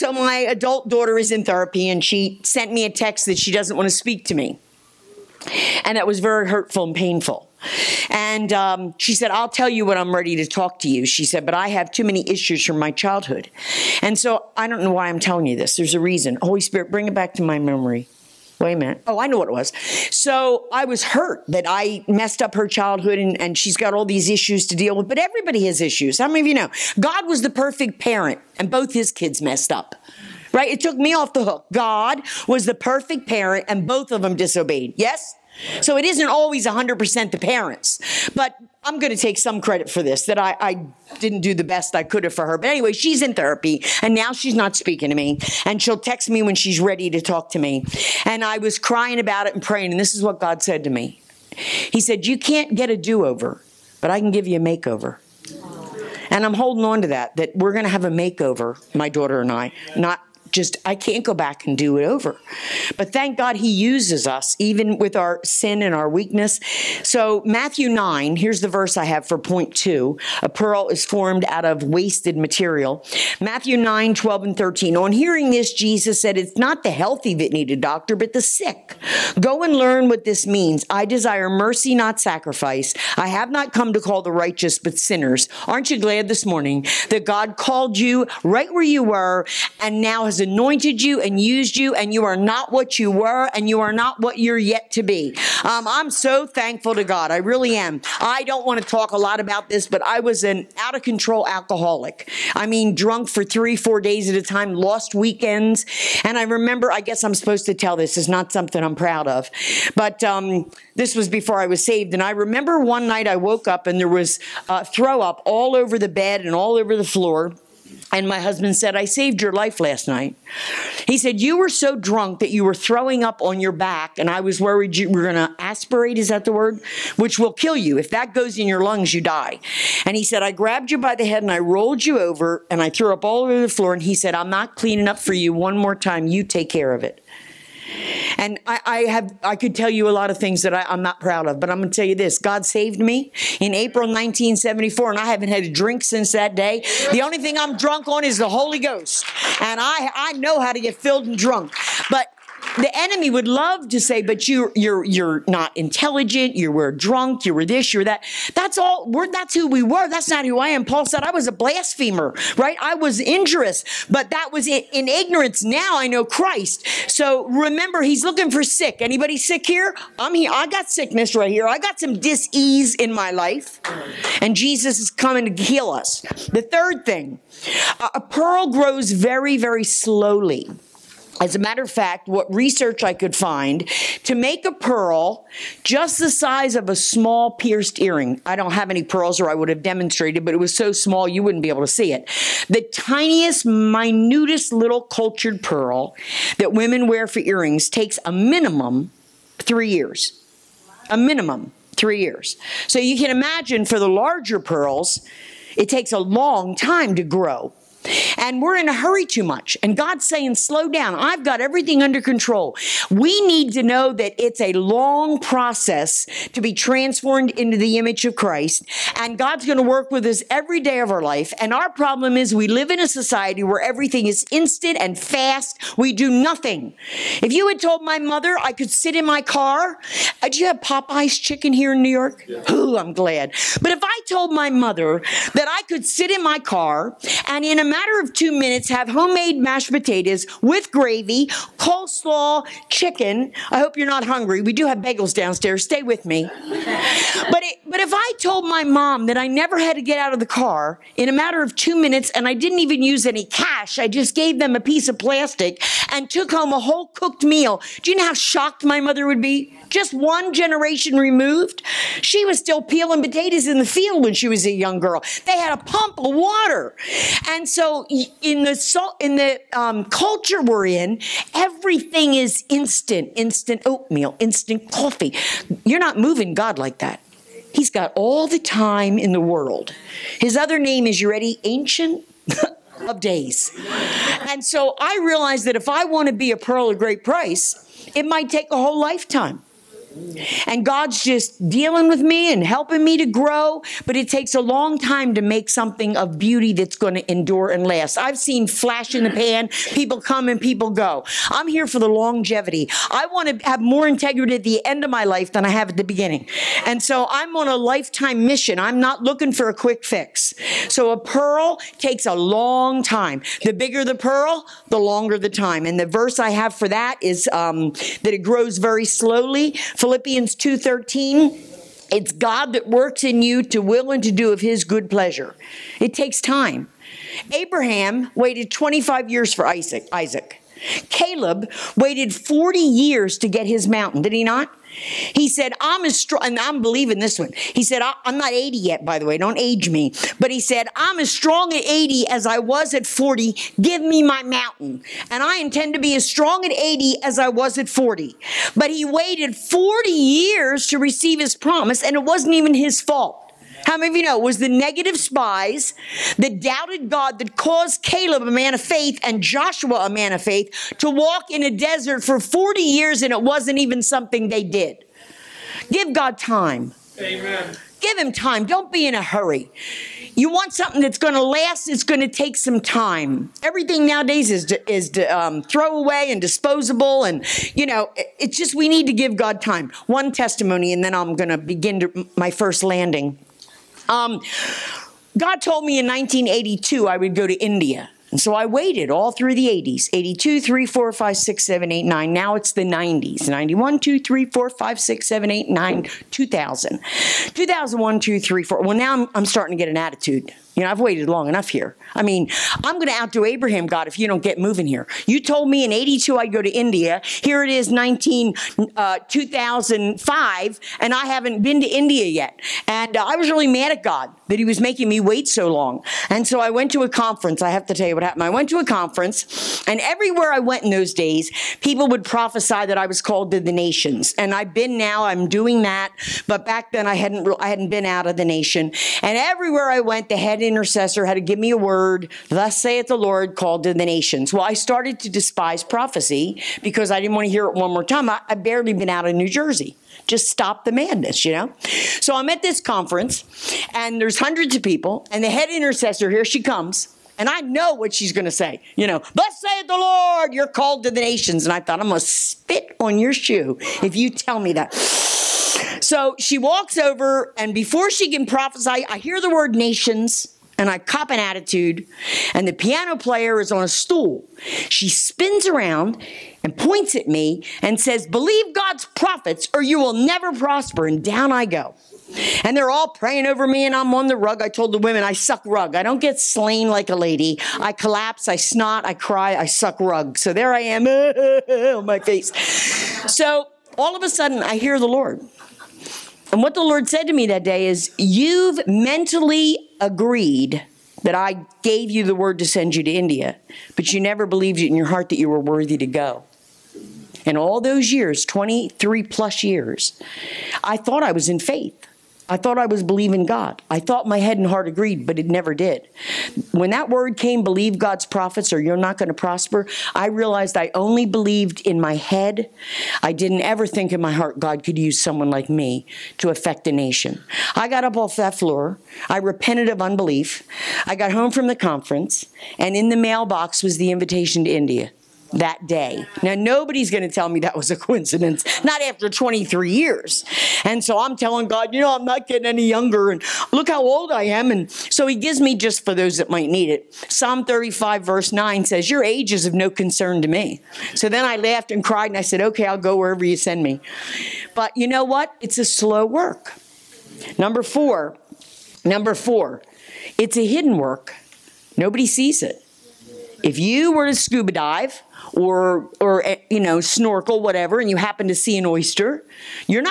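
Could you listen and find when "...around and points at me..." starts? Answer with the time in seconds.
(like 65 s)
465 s.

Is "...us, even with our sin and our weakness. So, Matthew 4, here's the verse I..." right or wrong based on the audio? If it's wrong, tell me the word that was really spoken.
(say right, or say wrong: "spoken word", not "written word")
wrong: "9", not "4".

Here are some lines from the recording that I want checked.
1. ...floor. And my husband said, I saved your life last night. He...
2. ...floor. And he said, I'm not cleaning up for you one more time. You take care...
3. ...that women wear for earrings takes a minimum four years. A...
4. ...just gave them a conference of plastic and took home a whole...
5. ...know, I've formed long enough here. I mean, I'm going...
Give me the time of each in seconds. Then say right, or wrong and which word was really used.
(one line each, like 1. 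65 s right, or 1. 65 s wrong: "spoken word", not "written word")
1. 117 s right
2. 133 s right
3. 196 s wrong: "three", not "four"
4. 254 s wrong: "piece", not "conference"
5. 400 s wrong: "waited", not "formed".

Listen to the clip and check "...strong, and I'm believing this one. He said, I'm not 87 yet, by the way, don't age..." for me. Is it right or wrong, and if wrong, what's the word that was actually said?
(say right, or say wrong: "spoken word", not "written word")
wrong: "80", not "87".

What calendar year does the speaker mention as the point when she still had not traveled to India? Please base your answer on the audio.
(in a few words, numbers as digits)
2005.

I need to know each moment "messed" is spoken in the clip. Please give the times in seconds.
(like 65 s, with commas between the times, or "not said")
22 s, 29 s.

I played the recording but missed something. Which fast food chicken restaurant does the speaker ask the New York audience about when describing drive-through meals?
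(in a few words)
Popeyes.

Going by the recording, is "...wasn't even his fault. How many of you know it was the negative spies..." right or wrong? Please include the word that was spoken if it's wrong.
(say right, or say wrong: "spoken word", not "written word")
right.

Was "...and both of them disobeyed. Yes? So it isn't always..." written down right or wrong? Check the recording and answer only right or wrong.
right.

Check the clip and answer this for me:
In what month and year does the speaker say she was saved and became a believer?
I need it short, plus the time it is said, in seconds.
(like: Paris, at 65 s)
April 1974, at 143 s.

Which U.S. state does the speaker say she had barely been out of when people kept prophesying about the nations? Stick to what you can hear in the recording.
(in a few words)
New Jersey.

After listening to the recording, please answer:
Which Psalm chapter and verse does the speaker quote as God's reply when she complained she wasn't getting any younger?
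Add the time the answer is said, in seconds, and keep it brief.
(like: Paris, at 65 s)
Psalm 35:9, at 537 s.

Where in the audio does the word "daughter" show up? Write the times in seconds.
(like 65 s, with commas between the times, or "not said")
0 s, 59 s.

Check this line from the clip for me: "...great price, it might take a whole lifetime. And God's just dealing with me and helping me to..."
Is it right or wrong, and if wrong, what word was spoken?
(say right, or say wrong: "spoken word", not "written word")
right.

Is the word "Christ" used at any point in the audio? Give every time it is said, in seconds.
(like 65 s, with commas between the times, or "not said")
166 s, 218 s.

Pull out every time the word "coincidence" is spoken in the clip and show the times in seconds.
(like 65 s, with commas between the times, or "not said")
527 s.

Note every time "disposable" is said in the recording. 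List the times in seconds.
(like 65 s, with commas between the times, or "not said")
376 s.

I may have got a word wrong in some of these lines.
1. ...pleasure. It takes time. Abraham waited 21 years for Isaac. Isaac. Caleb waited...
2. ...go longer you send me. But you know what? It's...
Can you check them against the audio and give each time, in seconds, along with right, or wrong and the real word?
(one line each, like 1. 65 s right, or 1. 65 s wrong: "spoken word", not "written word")
1. 325 s wrong: "25", not "21"
2. 542 s wrong: "wherever", not "longer".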